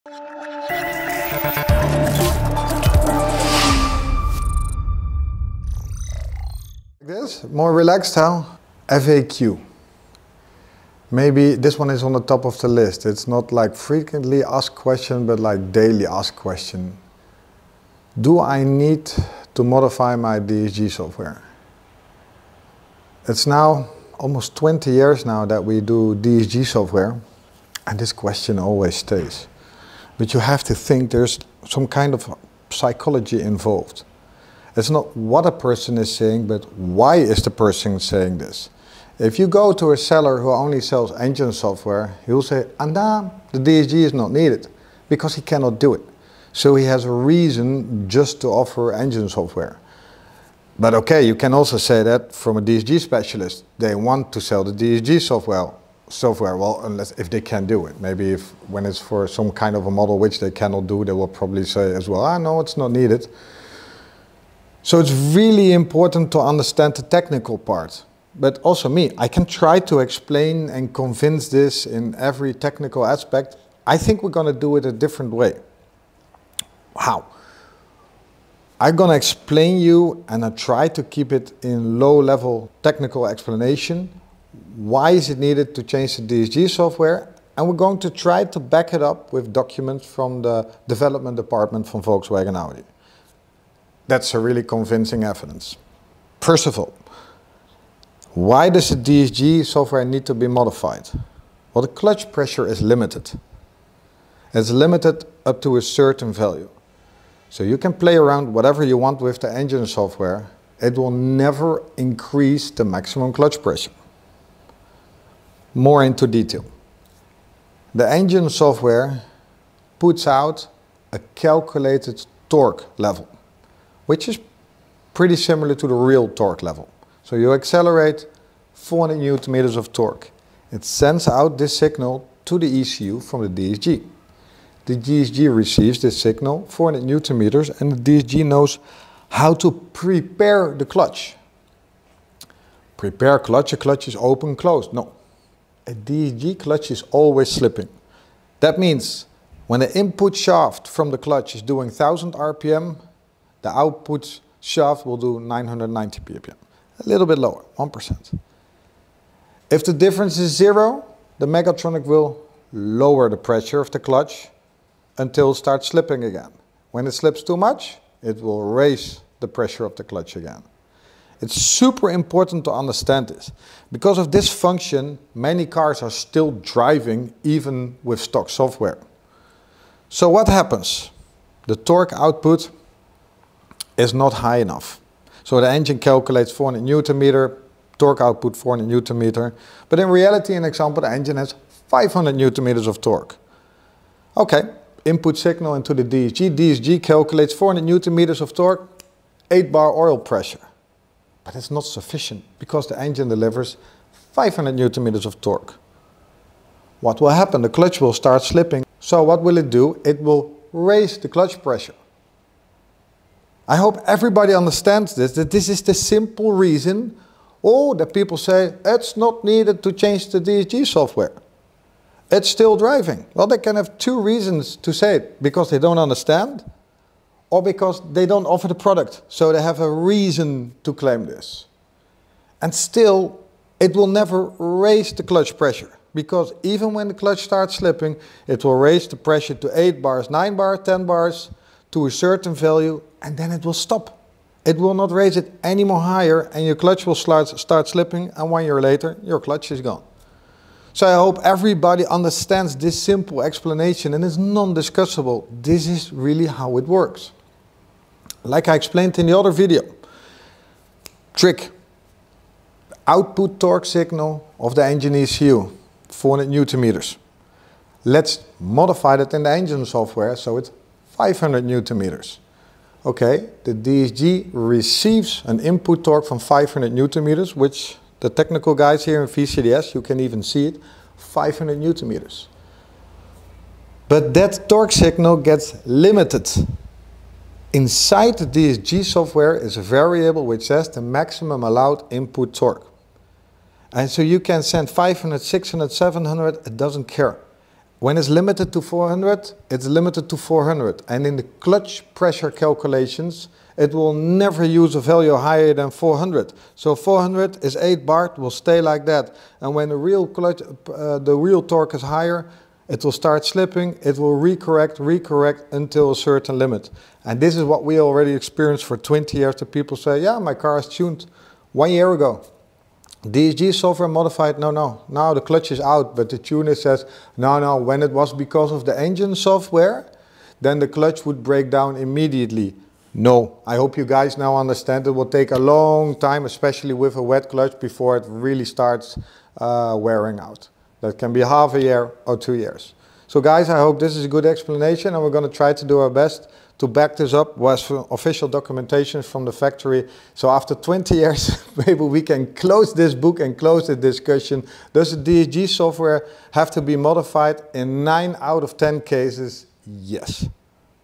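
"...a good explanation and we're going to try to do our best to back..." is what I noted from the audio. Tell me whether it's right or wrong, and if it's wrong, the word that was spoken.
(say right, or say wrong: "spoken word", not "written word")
right.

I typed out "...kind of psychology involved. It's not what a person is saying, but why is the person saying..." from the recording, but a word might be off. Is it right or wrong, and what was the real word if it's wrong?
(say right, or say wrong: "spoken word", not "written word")
right.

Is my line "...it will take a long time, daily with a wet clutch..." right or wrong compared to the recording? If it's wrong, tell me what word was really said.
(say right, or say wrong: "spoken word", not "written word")
wrong: "especially", not "daily".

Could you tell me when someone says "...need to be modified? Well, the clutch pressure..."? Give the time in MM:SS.
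01:40.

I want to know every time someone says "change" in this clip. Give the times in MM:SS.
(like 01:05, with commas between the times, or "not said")
01:25, 03:39.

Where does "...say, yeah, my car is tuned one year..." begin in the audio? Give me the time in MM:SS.
05:19.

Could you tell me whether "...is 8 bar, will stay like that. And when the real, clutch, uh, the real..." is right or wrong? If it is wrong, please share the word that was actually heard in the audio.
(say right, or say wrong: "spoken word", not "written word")
right.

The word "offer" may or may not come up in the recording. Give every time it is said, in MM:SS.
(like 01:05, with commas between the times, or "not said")
00:48, 03:48.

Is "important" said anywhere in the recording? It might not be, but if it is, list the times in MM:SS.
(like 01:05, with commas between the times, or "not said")
01:05, 02:52.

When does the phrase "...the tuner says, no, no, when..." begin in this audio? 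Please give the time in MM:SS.
05:26.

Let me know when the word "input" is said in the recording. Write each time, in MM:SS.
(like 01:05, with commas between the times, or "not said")
02:29, 03:15, 04:35, 04:52.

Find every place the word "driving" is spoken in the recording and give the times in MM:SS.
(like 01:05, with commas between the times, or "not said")
02:56, 03:42.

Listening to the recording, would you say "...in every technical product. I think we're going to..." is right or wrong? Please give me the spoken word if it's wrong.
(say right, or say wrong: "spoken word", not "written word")
wrong: "aspect", not "product".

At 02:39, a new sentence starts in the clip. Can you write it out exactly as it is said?
If the difference is zero, the Mechatronic will lower the pressure of the clutch until it starts slipping again.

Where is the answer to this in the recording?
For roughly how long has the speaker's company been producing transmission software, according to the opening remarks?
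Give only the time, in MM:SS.
00:24.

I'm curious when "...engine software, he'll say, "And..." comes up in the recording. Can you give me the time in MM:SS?
00:41.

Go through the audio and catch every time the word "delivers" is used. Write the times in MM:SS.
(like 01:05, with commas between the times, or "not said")
03:23.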